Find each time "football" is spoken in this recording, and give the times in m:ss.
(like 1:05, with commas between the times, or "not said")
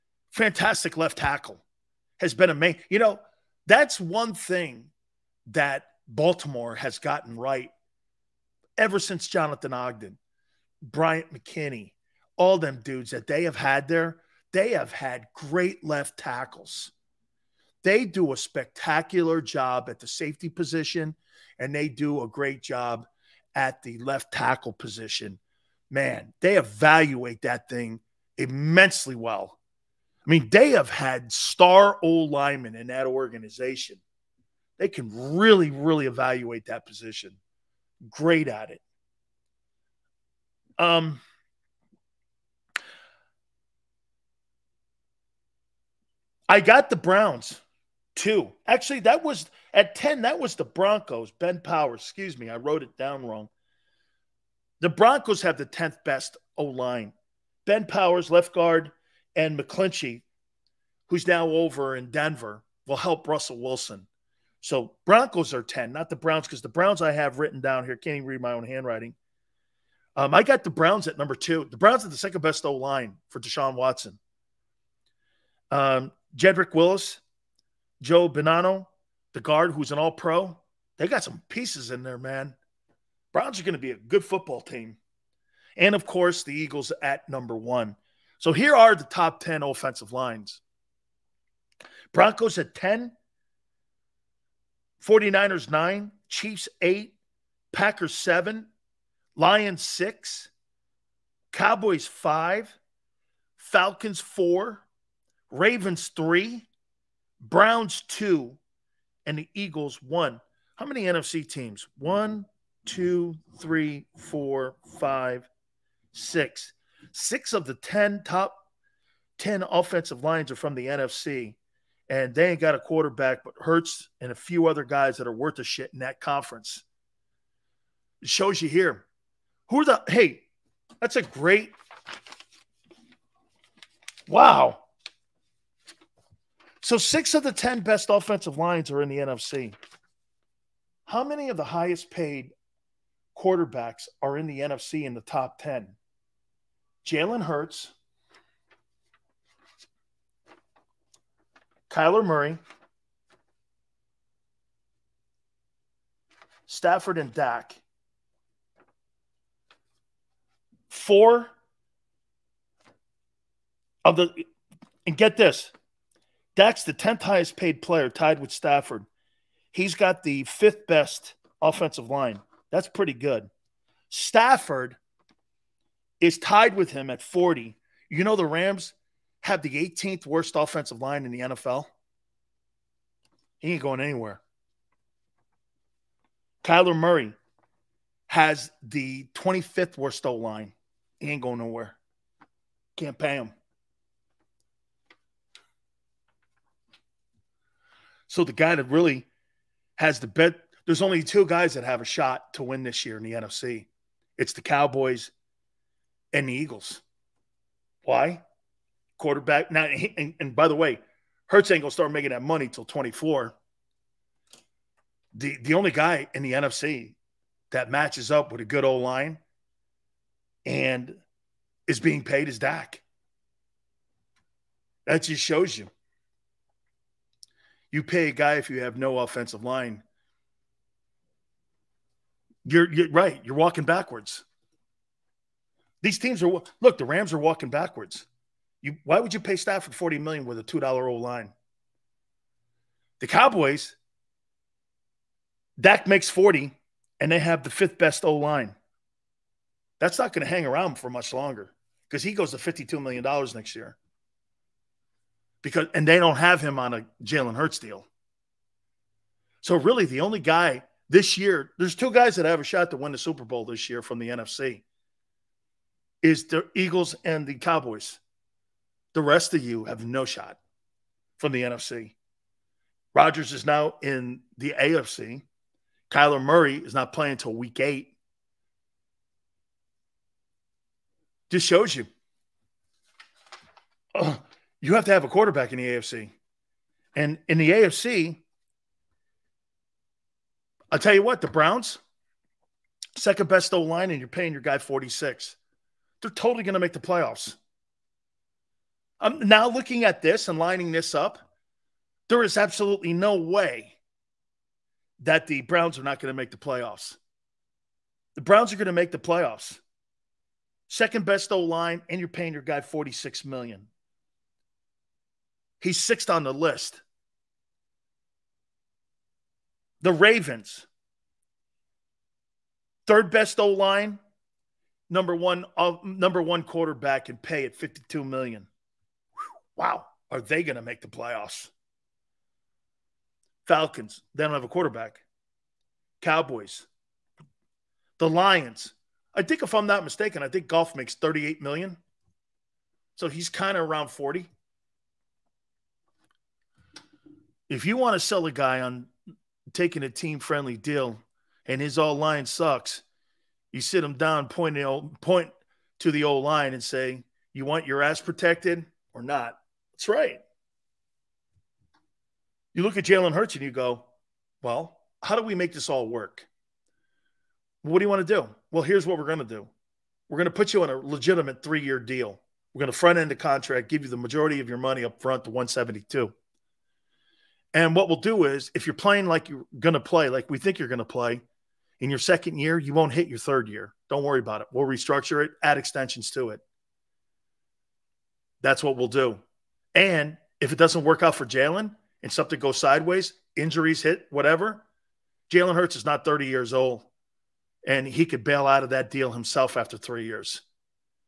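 1:24.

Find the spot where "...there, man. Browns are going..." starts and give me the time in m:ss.
1:22.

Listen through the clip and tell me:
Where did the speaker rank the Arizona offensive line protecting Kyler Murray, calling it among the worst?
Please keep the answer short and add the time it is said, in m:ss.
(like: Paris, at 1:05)
25th, at 3:09.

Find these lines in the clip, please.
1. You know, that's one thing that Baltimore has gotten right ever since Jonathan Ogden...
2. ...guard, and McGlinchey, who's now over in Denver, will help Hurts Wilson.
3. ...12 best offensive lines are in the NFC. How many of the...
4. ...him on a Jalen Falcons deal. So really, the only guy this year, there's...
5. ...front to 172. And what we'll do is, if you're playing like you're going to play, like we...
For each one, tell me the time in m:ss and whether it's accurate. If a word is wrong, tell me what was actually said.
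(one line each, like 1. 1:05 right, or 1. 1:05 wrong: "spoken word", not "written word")
1. 0:02 right
2. 0:58 wrong: "Russell", not "Hurts"
3. 2:17 wrong: "10", not "12"
4. 4:16 wrong: "Hurts", not "Falcons"
5. 6:15 right.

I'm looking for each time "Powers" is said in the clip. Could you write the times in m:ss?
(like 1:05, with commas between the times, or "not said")
0:51, 0:57.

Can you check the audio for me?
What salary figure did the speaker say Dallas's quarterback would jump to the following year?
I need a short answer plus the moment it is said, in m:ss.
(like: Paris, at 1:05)
52 million, at 4:12.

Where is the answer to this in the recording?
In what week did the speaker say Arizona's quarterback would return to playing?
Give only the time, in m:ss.
4:37.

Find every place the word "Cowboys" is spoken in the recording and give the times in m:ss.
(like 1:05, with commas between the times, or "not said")
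1:41, 3:24, 4:03, 4:27, 5:36.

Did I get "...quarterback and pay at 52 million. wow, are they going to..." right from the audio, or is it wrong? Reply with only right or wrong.
right.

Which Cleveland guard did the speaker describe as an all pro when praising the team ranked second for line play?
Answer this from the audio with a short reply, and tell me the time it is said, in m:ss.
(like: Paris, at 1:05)
Joe Bonanno, at 1:18.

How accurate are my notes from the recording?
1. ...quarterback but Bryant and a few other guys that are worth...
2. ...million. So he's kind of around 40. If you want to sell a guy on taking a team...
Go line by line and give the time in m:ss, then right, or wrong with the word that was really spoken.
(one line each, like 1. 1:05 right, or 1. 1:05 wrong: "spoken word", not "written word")
1. 2:02 wrong: "Hurts", not "Bryant"
2. 5:41 right.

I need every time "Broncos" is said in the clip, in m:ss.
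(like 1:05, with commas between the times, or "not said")
0:50, 0:54, 1:05, 1:32.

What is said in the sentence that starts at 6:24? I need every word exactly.
We'll restructure it, add extensions to it.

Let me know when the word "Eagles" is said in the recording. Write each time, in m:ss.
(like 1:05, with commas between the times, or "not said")
1:26, 1:49, 3:26, 4:26.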